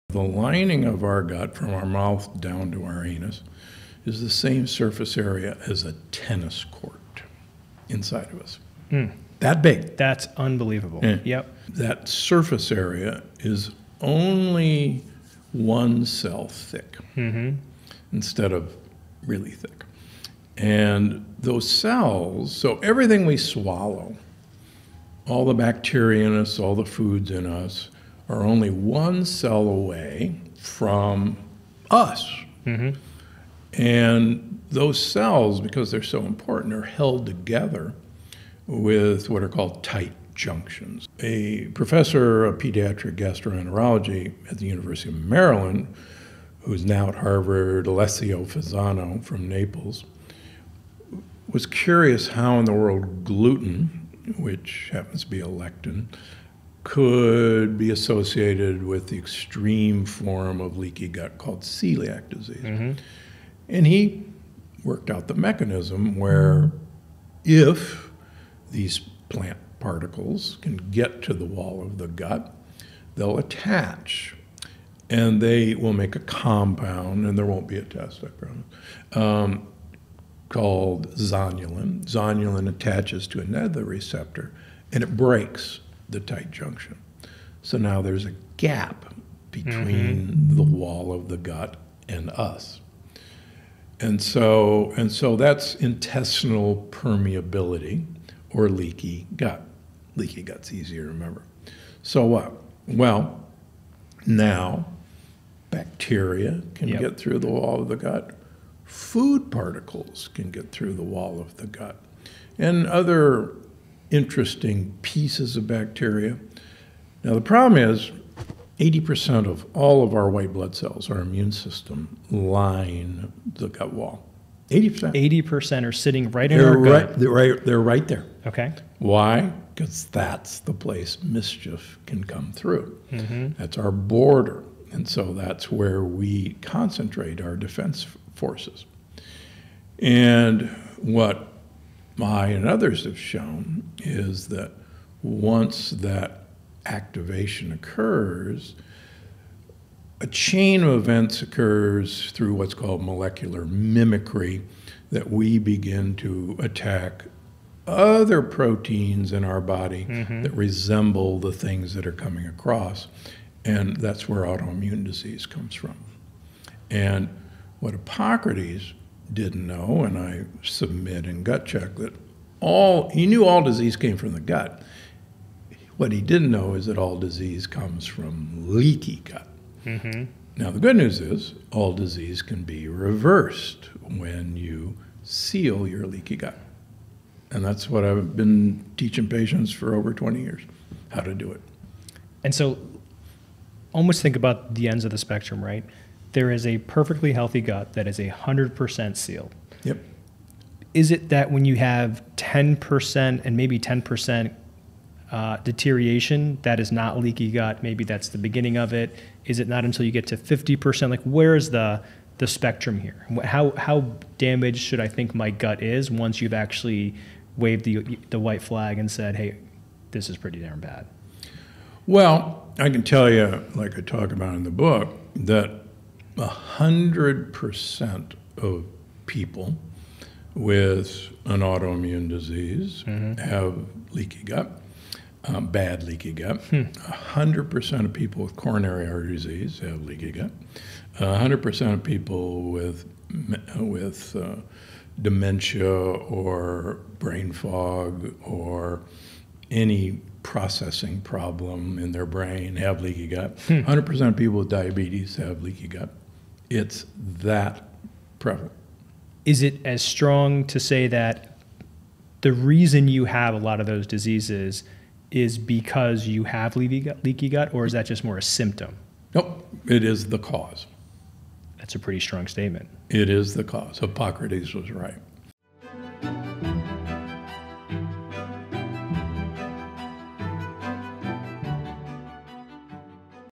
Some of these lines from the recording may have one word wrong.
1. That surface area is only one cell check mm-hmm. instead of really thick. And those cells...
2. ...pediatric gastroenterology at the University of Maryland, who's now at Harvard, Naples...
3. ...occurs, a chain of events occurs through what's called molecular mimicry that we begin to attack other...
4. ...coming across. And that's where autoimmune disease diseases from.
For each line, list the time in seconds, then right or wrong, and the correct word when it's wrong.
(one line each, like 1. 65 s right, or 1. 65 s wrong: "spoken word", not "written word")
1. 11 s wrong: "thick", not "check"
2. 42 s wrong: "Alessio", not "Naples"
3. 147 s right
4. 162 s wrong: "comes", not "diseases".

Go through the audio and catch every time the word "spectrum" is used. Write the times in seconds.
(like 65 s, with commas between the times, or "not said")
195 s, 212 s.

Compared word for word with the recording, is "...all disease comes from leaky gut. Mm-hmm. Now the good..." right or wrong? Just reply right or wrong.
right.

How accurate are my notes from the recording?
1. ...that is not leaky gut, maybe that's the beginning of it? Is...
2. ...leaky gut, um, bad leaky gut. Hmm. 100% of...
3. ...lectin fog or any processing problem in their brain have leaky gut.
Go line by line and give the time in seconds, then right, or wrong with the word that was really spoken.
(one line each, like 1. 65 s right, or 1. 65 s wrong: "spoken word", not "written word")
1. 206 s right
2. 234 s right
3. 247 s wrong: "brain", not "lectin".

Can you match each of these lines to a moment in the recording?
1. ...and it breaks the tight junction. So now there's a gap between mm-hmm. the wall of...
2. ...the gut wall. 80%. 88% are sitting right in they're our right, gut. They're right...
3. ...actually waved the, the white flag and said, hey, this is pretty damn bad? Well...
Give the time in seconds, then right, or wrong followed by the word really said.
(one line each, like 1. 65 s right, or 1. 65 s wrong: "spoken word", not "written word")
1. 84 s right
2. 123 s wrong: "80", not "88"
3. 216 s right.